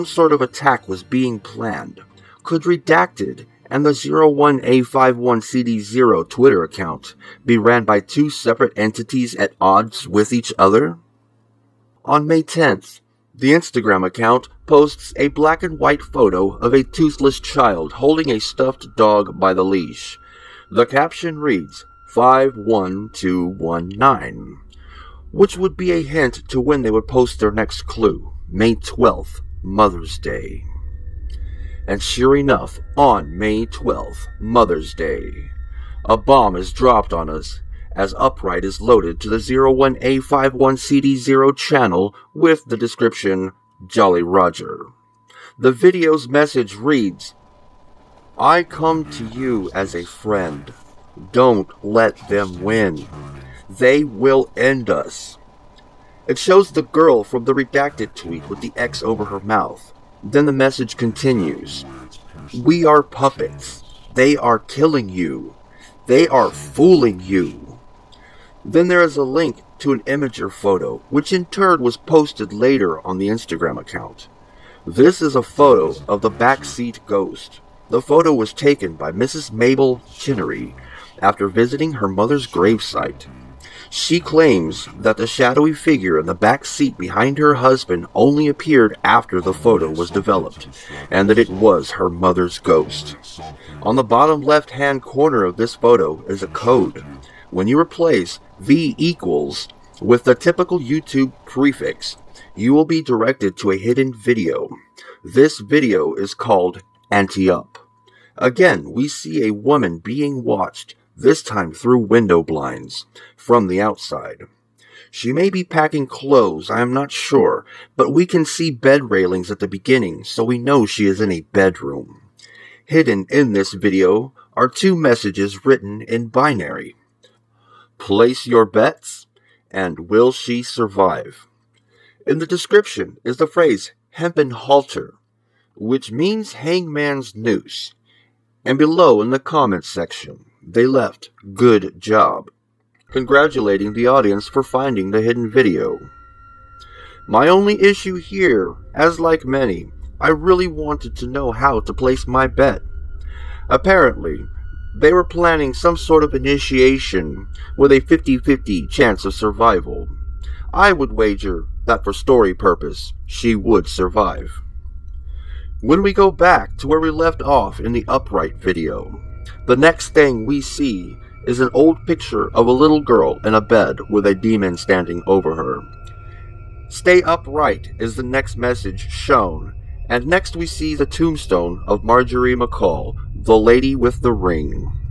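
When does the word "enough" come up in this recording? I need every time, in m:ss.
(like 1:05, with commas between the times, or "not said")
0:32.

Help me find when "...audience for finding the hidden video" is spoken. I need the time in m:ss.
2:24.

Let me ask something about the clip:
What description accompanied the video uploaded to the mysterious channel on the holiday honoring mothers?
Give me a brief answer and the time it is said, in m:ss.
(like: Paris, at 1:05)
Jolly Roger, at 0:43.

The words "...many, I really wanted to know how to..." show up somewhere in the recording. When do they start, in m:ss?
2:29.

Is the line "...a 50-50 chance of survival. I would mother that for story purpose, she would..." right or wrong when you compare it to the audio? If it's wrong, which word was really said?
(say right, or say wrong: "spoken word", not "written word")
wrong: "wager", not "mother".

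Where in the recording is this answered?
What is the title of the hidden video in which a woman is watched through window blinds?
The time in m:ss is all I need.
1:47.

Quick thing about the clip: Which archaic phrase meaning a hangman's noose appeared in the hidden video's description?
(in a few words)
hempen halter.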